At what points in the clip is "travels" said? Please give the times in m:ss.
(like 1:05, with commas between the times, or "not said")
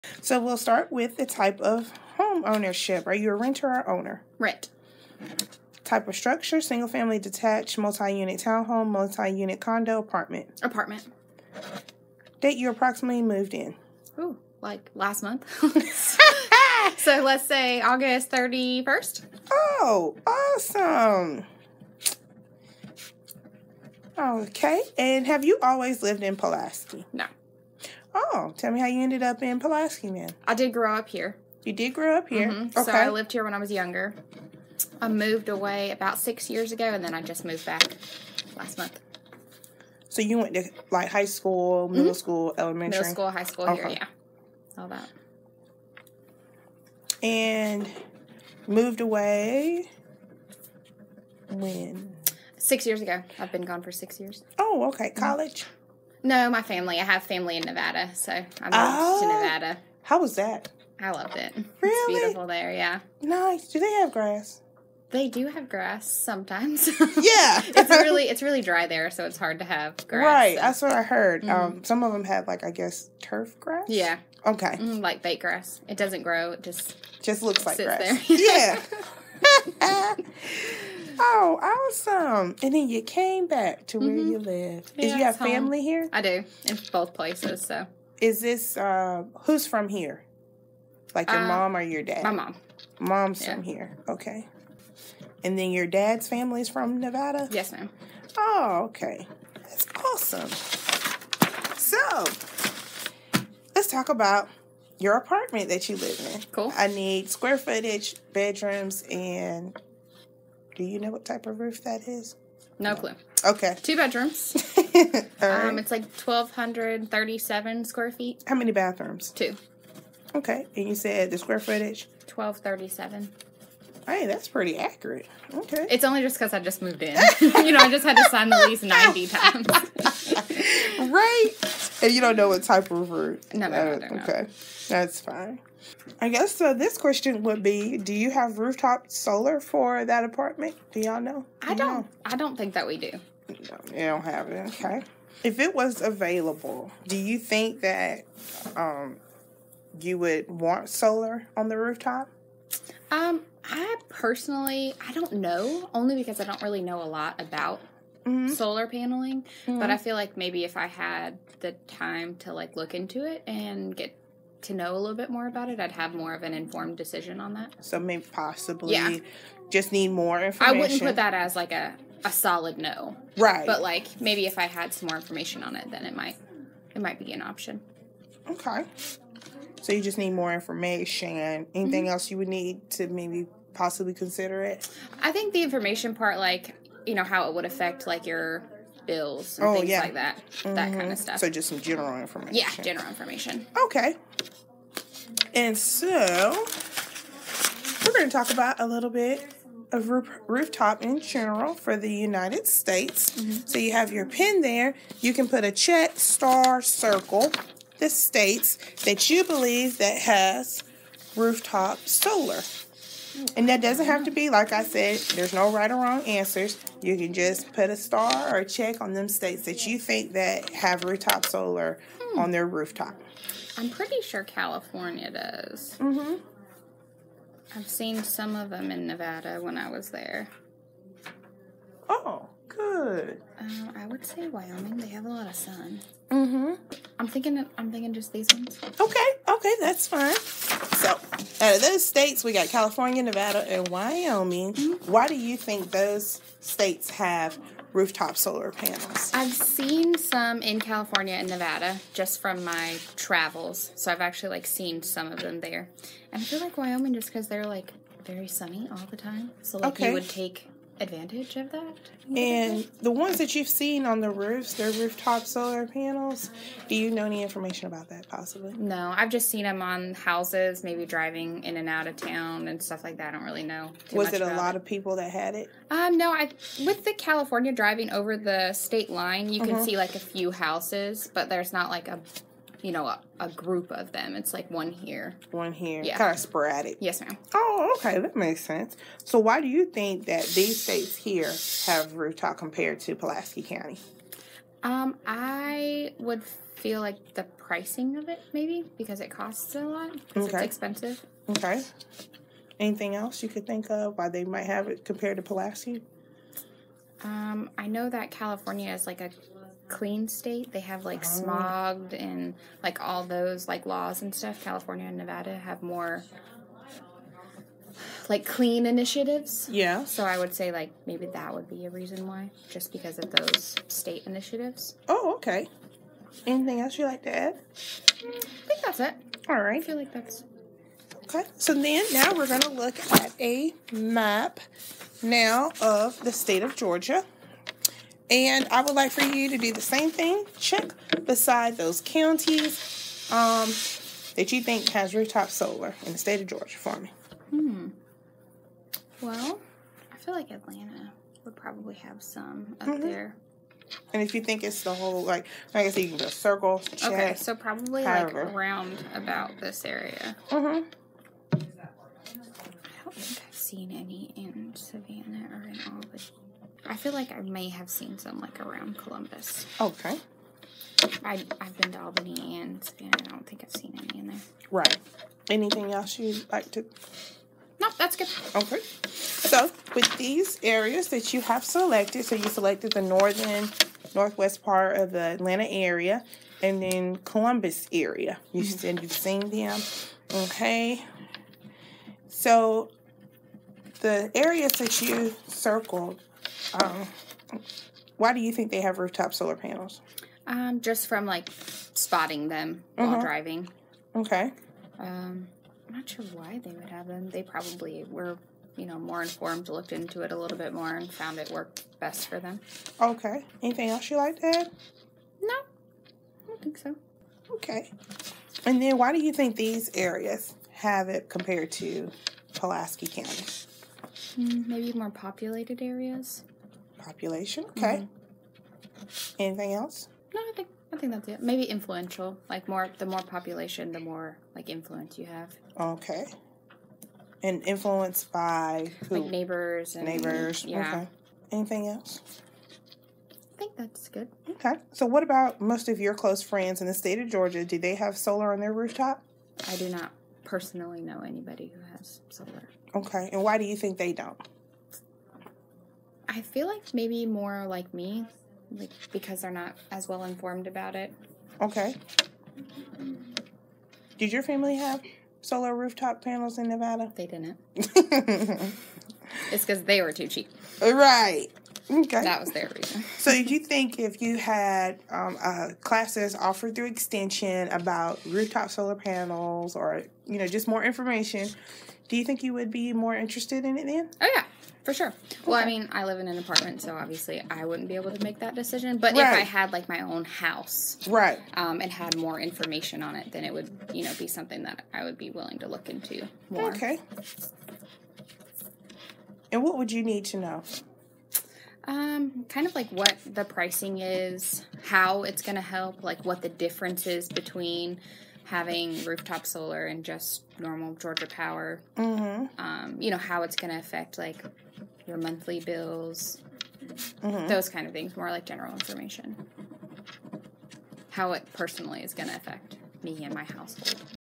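4:13.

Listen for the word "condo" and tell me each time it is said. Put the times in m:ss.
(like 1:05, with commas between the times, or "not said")
0:09.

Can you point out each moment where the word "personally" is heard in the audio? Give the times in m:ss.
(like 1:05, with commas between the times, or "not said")
2:34, 7:30, 8:41.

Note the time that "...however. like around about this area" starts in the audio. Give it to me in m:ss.
5:58.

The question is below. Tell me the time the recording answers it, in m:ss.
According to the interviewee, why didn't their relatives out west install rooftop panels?
7:50.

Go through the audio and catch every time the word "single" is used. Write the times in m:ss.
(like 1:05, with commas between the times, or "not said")
0:06.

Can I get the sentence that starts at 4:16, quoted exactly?
And I feel like Wyoming just because they're like very sunny all the time.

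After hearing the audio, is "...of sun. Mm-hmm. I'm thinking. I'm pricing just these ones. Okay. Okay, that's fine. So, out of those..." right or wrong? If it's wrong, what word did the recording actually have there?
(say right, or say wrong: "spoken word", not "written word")
wrong: "thinking", not "pricing".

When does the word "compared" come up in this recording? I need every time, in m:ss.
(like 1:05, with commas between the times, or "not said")
4:52, 5:05, 7:01.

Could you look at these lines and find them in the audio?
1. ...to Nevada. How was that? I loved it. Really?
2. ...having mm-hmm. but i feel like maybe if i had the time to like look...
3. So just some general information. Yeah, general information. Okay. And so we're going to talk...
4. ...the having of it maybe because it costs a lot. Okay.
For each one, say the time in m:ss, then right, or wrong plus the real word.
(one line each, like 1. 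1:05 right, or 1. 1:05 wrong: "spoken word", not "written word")
1. 0:59 right
2. 2:38 wrong: "paneling", not "having"
3. 3:11 right
4. 4:57 wrong: "pricing", not "having".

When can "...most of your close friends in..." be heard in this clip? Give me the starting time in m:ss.
7:25.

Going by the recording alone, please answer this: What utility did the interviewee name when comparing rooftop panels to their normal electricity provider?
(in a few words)
Georgia Power.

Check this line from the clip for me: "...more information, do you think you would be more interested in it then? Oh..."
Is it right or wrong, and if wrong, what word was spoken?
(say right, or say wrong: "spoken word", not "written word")
right.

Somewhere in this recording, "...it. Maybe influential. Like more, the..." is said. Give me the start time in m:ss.
7:11.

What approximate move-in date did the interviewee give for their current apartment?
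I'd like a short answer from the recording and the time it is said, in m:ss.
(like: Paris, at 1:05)
August 31st, at 0:17.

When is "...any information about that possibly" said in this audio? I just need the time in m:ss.
4:27.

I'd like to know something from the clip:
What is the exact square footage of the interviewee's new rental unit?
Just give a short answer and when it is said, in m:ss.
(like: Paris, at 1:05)
1,237, at 1:56.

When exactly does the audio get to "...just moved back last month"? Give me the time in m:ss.
0:37.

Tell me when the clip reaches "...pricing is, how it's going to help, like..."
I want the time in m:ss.
8:23.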